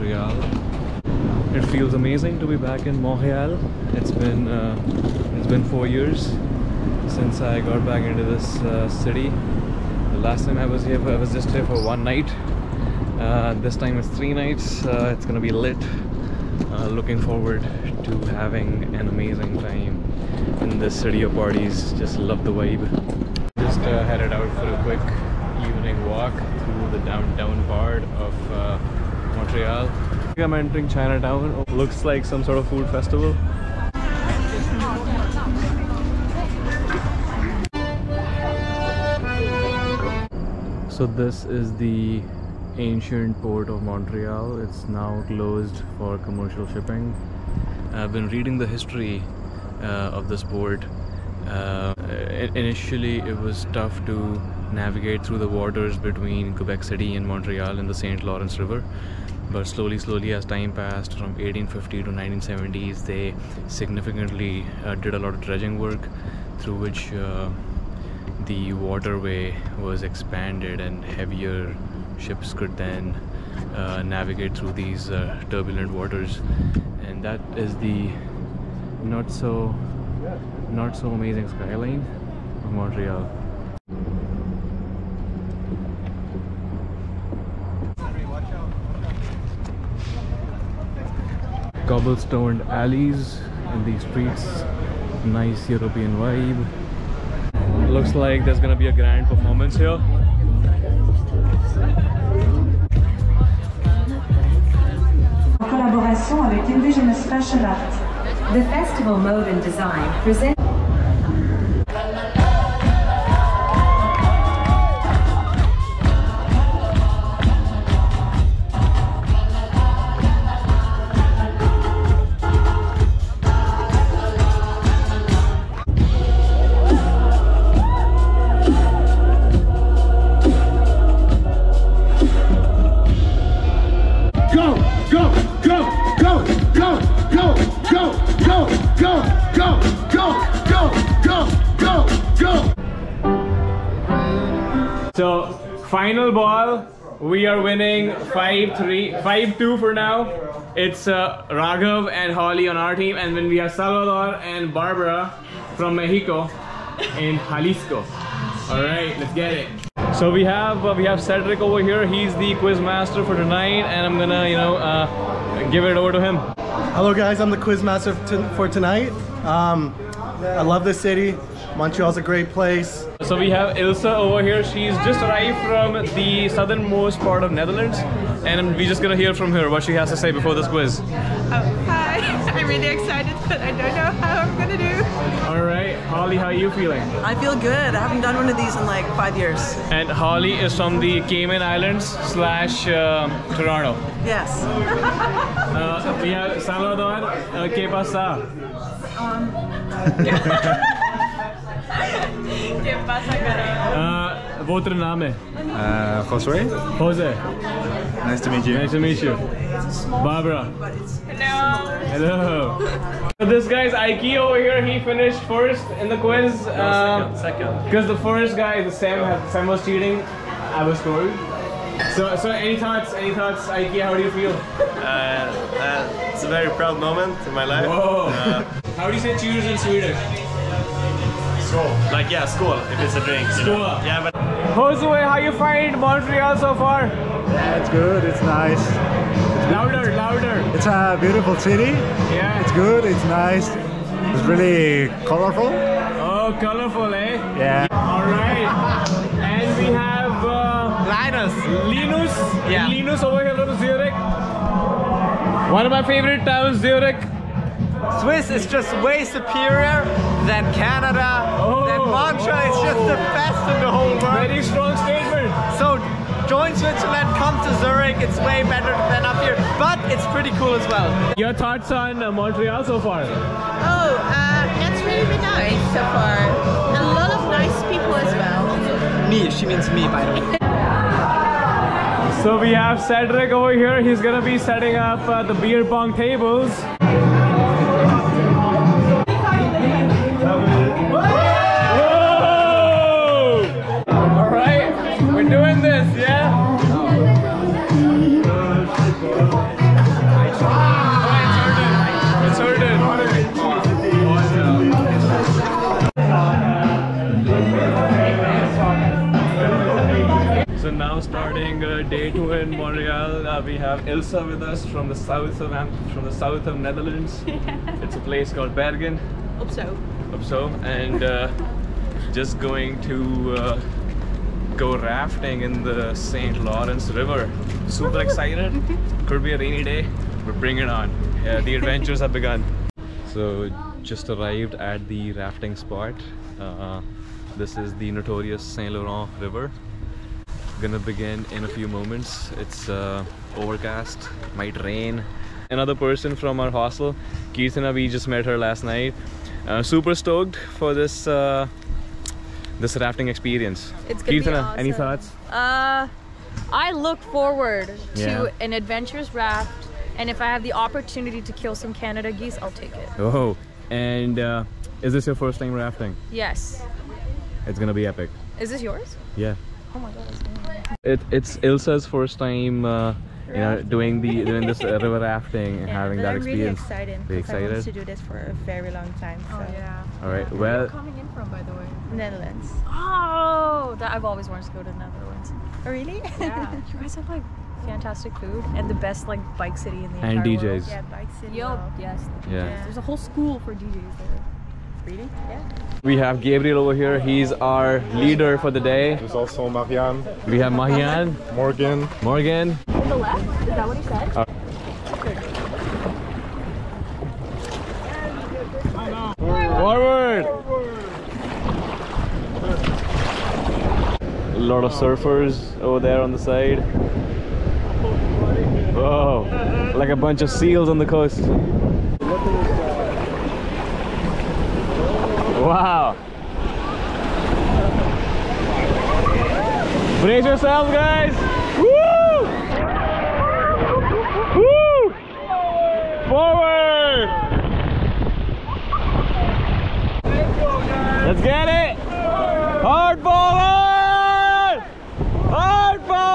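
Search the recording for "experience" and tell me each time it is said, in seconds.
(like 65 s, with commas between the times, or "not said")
353 s, 376 s.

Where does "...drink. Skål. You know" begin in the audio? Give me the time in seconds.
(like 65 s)
233 s.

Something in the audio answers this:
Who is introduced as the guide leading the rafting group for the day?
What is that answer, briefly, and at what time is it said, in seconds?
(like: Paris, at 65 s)
Gabriel, at 396 s.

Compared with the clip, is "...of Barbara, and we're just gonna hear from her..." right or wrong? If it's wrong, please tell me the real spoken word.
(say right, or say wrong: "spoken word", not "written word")
wrong: "Netherlands", not "Barbara".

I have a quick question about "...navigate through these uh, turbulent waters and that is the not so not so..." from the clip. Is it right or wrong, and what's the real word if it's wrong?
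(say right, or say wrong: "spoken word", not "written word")
right.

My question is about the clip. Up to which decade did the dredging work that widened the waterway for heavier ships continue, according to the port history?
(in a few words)
1970s.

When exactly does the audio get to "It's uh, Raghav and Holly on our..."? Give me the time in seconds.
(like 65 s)
150 s.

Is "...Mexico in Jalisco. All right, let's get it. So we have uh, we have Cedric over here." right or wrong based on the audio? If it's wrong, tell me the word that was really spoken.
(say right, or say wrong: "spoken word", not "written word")
right.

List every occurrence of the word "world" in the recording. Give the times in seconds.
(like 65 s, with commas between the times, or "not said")
264 s, 390 s.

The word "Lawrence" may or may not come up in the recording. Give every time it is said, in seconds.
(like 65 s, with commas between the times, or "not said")
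58 s, 326 s.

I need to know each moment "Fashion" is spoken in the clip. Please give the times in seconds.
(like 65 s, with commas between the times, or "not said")
107 s.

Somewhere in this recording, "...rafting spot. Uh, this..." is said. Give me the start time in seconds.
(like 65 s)
335 s.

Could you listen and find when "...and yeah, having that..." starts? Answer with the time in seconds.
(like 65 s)
375 s.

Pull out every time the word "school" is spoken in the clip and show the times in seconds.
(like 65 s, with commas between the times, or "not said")
393 s.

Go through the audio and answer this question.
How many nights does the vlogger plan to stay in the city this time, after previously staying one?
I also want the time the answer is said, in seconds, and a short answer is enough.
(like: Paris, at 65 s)
3, at 14 s.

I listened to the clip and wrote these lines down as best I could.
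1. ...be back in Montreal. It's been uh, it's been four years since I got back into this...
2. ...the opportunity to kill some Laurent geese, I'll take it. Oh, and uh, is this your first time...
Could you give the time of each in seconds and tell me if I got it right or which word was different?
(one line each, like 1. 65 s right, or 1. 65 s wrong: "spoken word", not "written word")
1. 2 s right
2. 360 s wrong: "Canada", not "Laurent".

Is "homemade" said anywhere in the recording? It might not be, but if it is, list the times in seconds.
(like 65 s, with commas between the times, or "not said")
not said.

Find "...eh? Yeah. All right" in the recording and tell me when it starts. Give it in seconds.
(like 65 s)
247 s.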